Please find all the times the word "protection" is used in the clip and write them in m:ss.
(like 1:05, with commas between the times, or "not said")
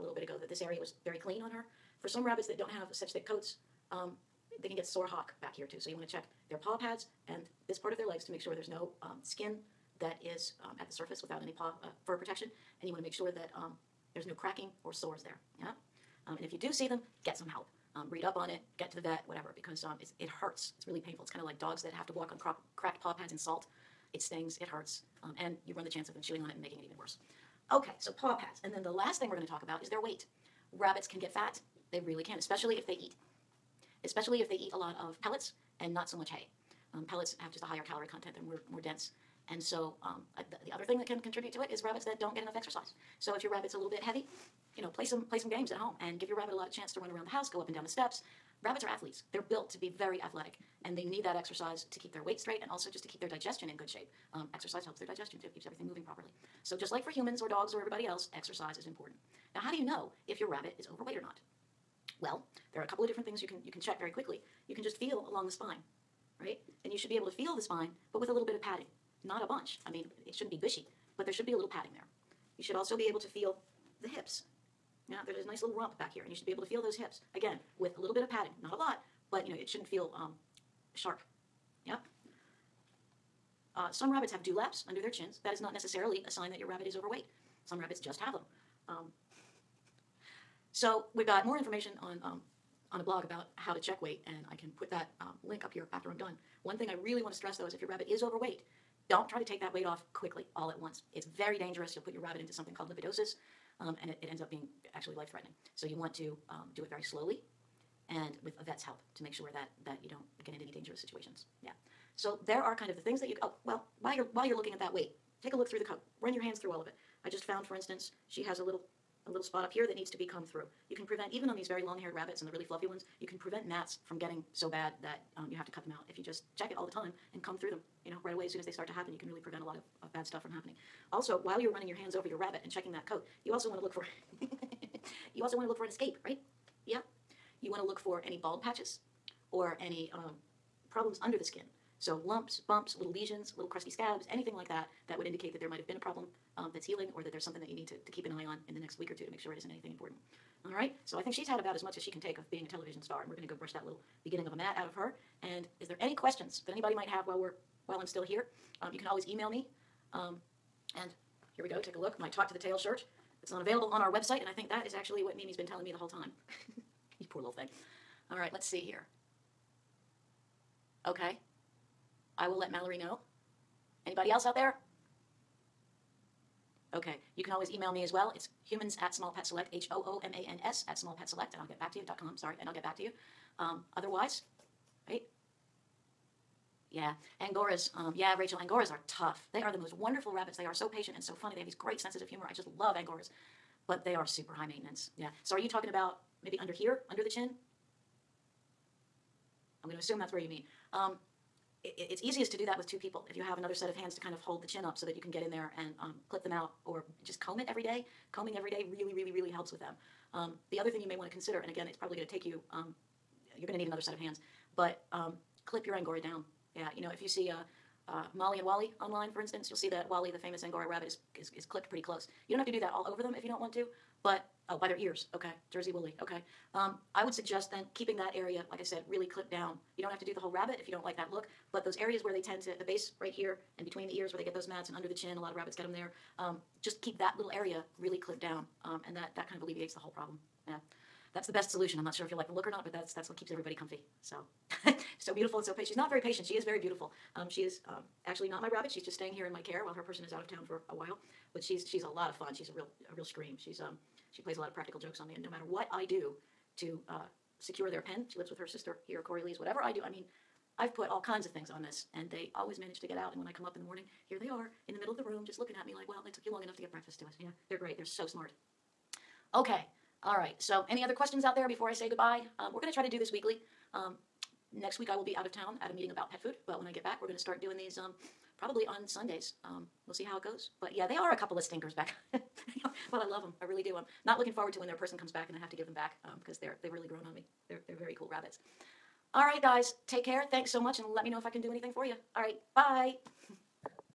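0:12.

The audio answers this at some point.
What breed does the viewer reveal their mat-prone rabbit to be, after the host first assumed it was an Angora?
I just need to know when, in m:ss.
3:45.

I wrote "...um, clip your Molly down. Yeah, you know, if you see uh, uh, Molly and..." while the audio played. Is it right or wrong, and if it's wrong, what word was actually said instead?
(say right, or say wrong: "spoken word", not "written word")
wrong: "Angora", not "Molly".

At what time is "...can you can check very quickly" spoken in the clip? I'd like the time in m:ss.
1:03.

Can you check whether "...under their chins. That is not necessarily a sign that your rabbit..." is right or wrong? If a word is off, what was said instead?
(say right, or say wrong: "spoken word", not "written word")
right.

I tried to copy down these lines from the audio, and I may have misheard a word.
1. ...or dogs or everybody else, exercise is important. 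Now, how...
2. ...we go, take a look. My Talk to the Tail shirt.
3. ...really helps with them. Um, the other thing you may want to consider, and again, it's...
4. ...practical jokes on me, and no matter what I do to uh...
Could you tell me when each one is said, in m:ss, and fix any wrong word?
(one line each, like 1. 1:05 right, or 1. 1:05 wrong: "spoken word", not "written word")
1. 0:57 right
2. 2:41 right
3. 3:29 right
4. 4:14 right.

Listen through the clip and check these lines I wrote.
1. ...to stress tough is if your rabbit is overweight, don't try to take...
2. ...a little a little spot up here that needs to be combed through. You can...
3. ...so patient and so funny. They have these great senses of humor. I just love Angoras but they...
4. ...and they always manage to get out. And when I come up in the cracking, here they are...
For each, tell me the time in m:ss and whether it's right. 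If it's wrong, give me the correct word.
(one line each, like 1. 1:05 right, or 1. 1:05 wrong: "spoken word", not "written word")
1. 1:37 wrong: "though", not "tough"
2. 1:58 right
3. 3:10 right
4. 4:22 wrong: "morning", not "cracking".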